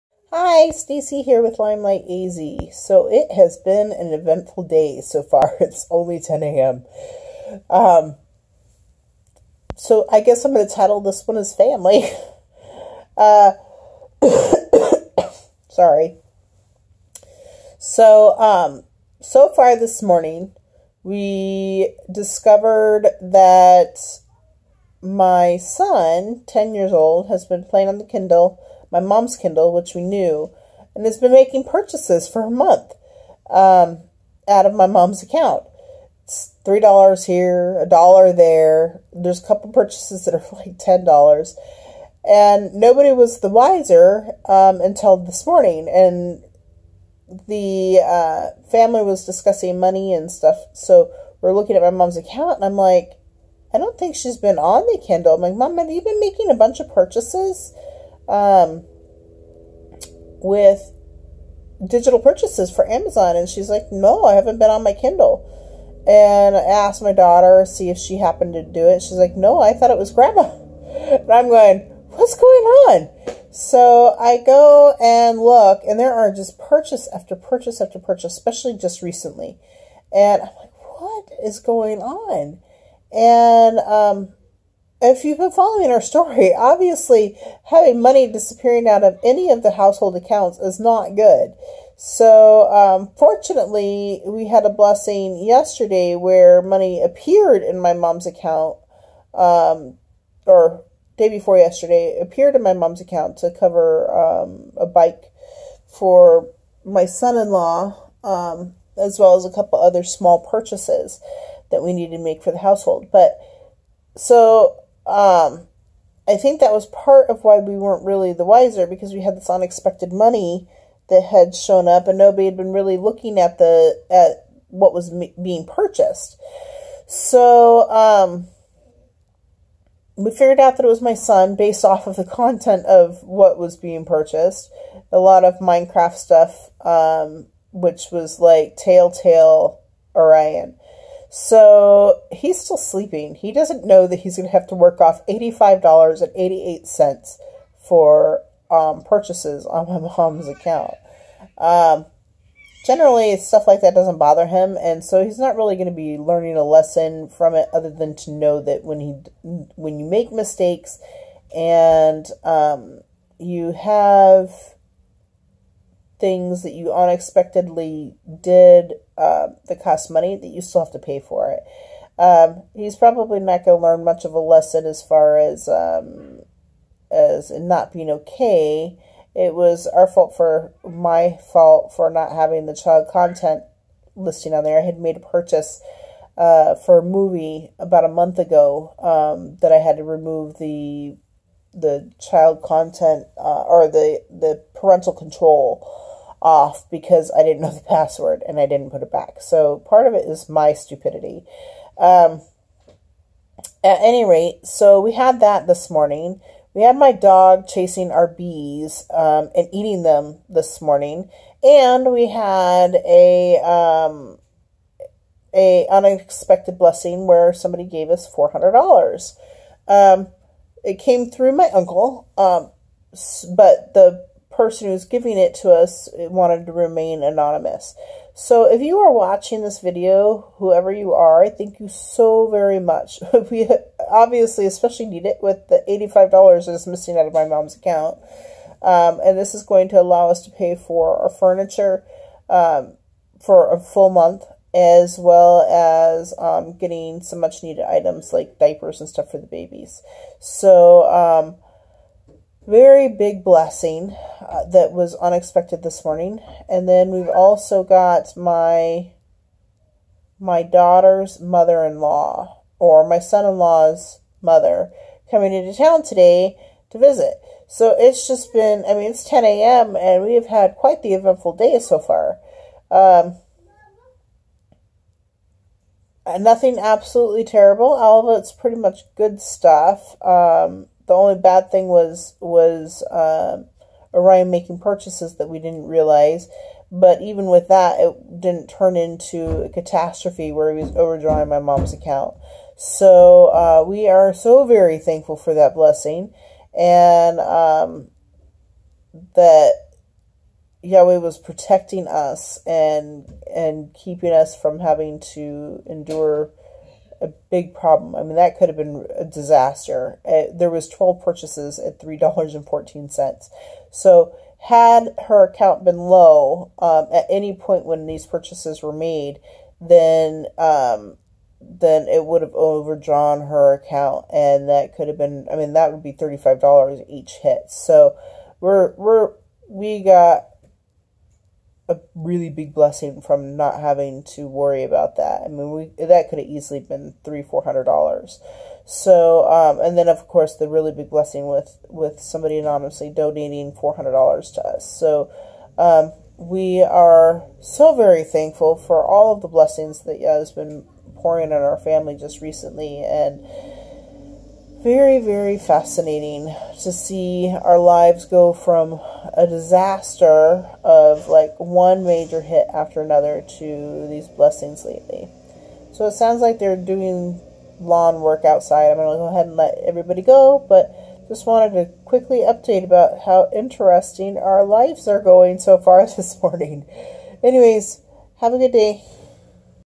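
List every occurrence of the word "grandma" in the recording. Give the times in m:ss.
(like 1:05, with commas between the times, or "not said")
1:10.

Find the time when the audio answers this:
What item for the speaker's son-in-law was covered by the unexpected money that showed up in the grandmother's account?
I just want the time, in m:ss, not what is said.
1:44.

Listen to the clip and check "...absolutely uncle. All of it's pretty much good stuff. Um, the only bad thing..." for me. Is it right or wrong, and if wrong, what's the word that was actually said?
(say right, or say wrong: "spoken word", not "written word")
wrong: "terrible", not "uncle".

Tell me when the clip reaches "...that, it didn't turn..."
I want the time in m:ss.
4:47.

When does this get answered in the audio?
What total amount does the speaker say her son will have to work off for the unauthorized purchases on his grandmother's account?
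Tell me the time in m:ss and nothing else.
2:25.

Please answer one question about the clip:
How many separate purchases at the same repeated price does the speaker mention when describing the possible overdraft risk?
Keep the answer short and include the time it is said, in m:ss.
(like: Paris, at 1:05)
12, at 5:10.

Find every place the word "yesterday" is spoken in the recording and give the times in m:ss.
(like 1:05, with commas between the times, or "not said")
1:35, 1:41.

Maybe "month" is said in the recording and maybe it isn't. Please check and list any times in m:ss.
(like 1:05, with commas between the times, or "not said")
0:32, 3:08, 4:04.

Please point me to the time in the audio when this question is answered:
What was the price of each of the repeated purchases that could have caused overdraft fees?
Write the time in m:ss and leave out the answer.
5:11.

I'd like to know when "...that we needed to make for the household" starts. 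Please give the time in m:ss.
1:51.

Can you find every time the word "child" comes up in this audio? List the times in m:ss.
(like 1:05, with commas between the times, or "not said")
3:02, 3:12.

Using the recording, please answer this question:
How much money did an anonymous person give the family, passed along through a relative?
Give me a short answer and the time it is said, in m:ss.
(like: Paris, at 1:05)
$400, at 3:38.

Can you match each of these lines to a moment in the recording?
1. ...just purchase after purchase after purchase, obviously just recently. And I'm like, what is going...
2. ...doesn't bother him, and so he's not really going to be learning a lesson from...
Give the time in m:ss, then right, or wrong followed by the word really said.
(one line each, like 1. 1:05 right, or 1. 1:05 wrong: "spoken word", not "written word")
1. 1:16 wrong: "especially", not "obviously"
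2. 2:33 right.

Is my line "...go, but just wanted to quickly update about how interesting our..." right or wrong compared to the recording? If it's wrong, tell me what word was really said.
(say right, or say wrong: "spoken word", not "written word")
right.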